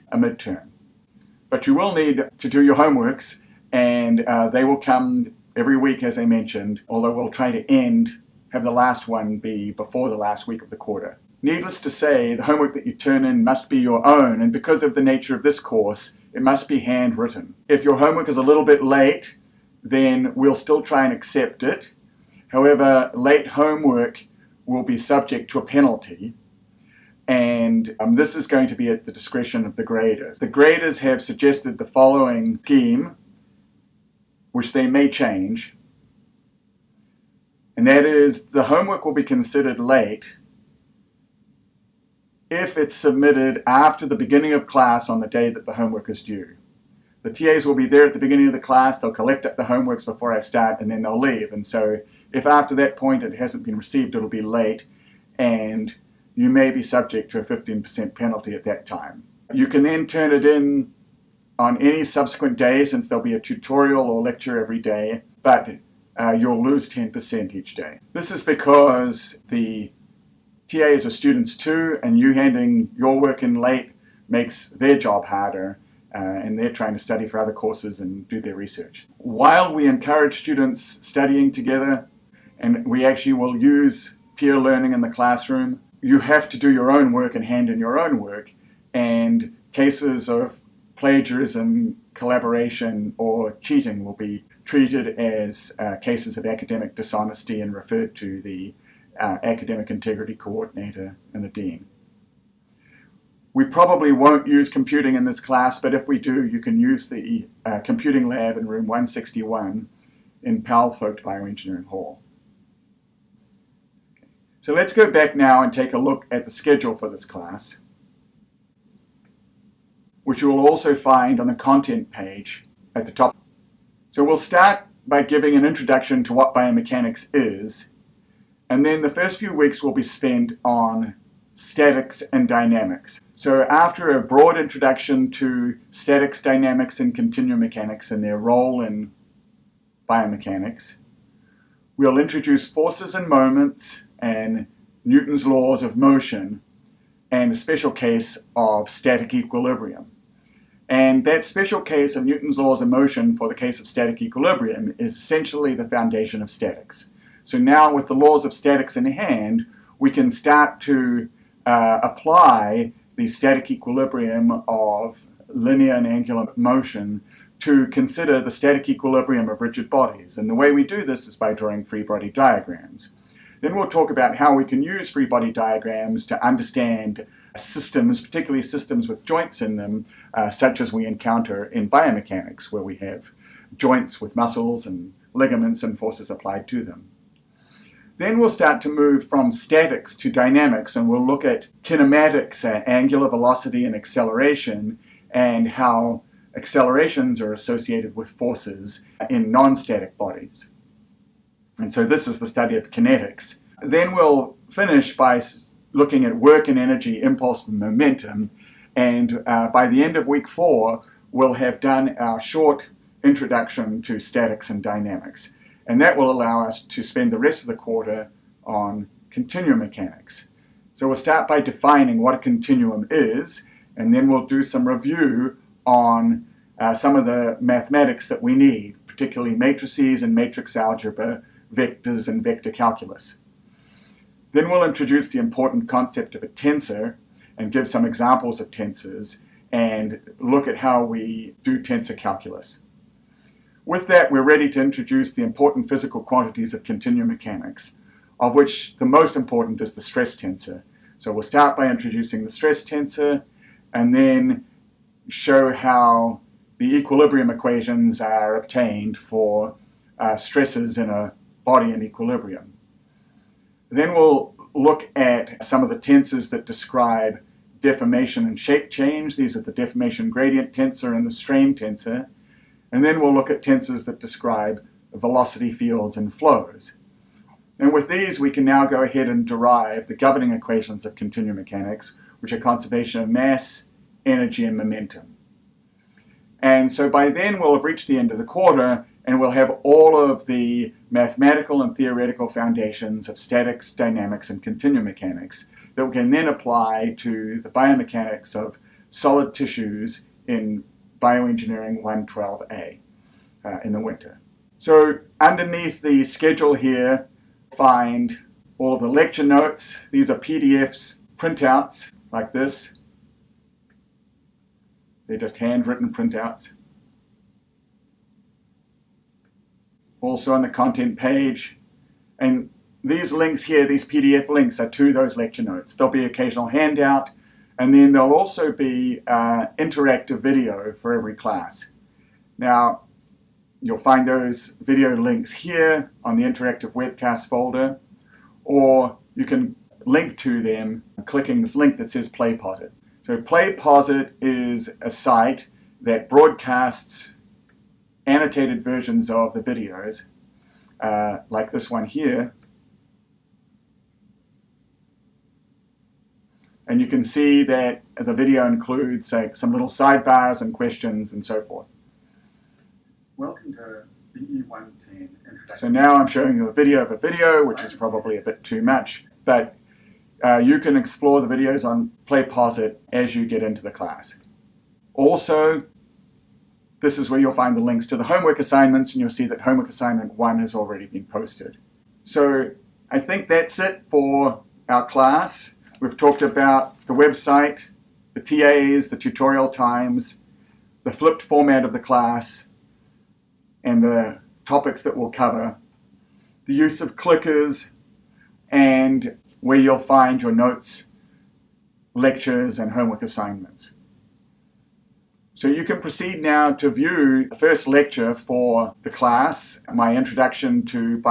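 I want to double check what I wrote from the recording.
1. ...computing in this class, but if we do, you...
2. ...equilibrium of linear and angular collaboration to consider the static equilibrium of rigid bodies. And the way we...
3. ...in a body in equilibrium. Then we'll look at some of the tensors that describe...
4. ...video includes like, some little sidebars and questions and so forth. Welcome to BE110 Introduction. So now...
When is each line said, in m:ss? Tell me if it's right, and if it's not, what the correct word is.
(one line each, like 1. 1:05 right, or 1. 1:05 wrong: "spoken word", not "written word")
1. 1:44 right
2. 2:43 wrong: "motion", not "collaboration"
3. 4:20 right
4. 5:58 right.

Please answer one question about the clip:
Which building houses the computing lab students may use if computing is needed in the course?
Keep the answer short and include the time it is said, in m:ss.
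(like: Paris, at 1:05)
Powell-Focht Bioengineering Hall, at 1:50.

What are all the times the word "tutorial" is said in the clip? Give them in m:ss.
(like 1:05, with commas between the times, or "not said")
1:03, 6:29.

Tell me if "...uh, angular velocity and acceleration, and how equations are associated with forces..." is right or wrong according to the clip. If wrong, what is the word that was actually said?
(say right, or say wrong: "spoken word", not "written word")
wrong: "accelerations", not "equations".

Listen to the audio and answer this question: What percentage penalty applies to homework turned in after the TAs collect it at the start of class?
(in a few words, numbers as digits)
15%.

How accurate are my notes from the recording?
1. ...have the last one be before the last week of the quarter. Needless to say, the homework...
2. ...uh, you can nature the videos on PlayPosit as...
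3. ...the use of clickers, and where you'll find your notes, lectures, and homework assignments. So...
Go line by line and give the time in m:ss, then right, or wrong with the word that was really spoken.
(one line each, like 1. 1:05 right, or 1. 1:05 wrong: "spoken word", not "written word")
1. 0:08 right
2. 6:10 wrong: "explore", not "nature"
3. 6:36 right.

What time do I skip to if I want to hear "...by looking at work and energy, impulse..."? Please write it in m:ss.
3:25.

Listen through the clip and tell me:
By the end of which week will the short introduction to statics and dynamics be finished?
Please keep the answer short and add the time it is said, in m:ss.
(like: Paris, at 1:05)
week four, at 3:30.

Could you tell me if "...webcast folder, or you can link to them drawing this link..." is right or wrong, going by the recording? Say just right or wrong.
wrong.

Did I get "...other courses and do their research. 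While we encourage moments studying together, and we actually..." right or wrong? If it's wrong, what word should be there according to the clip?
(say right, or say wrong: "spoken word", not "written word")
wrong: "students", not "moments".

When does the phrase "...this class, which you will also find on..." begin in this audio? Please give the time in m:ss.
1:57.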